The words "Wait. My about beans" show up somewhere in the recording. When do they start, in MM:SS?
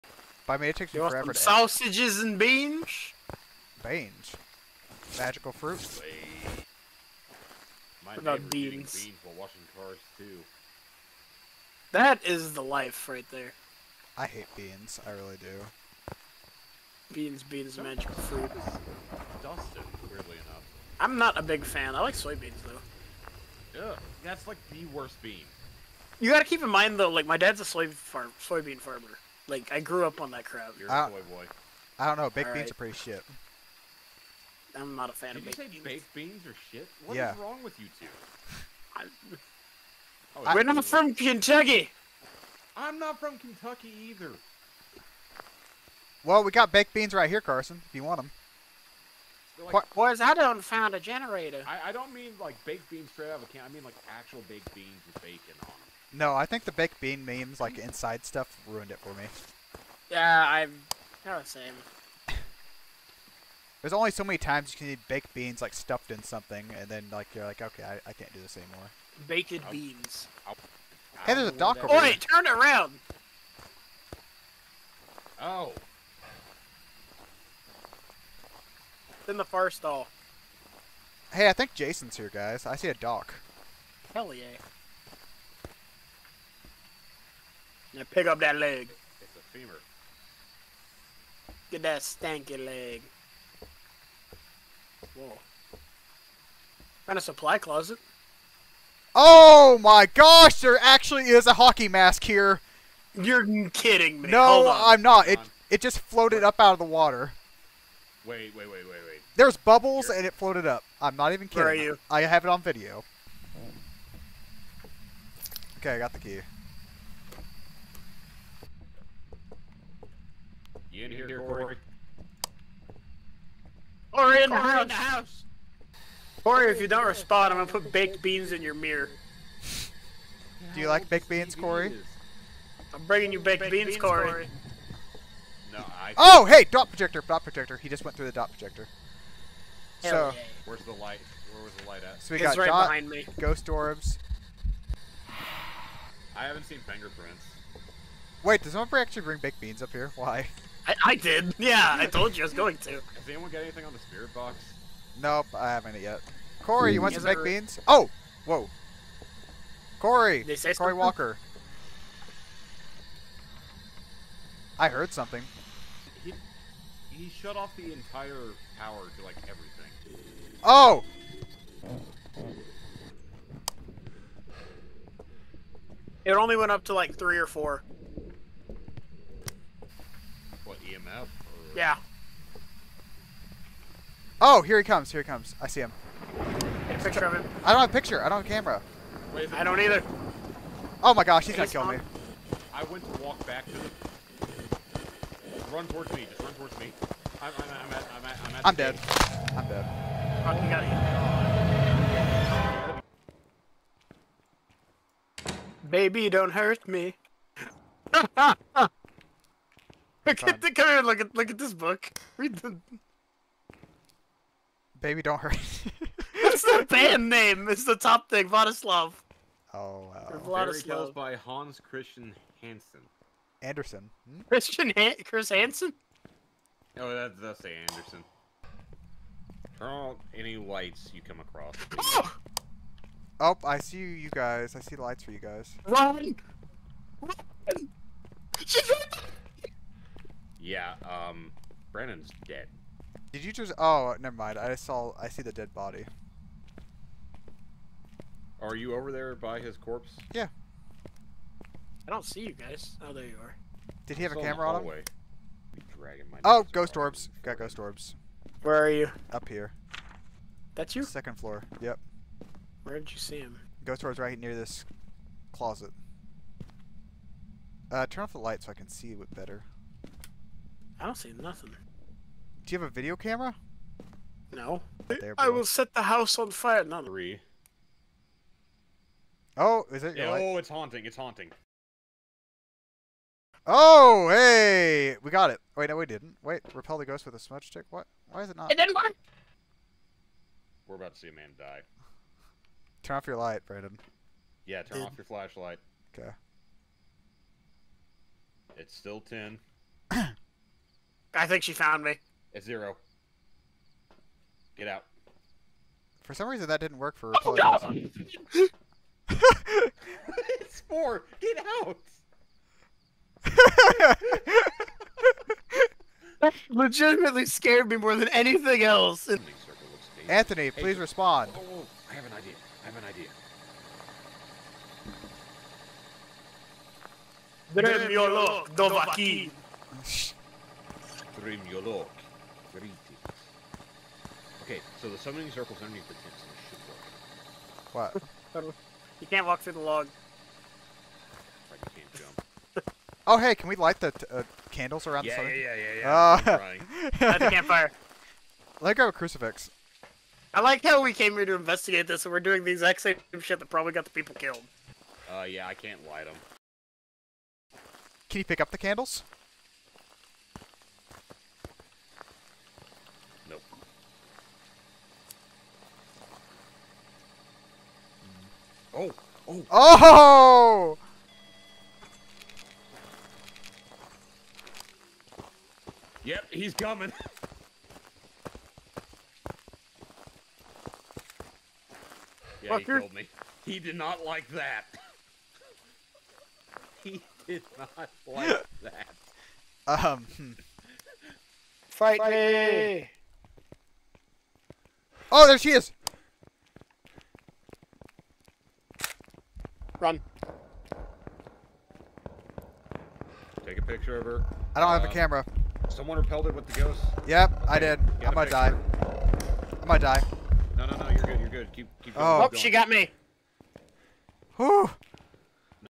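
00:06.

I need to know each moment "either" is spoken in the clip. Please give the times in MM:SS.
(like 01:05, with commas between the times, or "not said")
00:44, 03:09.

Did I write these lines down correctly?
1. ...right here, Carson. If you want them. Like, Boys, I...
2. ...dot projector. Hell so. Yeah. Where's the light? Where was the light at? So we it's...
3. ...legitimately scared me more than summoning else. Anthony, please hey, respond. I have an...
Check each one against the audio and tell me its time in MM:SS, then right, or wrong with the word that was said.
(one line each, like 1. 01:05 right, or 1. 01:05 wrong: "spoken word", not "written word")
1. 00:47 right
2. 02:18 right
3. 05:16 wrong: "anything", not "summoning".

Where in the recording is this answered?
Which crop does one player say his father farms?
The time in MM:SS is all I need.
00:28.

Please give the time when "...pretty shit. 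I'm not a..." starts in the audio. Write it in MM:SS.
00:32.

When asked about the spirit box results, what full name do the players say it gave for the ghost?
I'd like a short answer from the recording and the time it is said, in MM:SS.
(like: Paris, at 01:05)
Corey Walker, at 02:40.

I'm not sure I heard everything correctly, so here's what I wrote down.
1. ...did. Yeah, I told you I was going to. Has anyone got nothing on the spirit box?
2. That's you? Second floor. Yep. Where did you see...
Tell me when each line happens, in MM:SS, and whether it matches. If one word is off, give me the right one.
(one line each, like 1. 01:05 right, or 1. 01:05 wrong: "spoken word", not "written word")
1. 02:31 wrong: "anything", not "nothing"
2. 04:20 right.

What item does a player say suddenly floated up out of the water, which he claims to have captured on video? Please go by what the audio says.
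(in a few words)
Hockey mask.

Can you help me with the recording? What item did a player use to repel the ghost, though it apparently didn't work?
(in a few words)
Smudge stick.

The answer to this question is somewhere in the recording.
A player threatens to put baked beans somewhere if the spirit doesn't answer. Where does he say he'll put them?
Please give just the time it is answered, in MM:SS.
02:08.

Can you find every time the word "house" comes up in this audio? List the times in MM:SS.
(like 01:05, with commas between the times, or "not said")
02:04, 04:36.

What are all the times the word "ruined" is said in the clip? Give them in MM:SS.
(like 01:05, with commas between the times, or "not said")
00:58.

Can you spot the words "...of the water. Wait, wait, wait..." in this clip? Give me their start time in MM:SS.
01:46.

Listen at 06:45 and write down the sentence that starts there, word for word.
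Someone repelled it with the ghost.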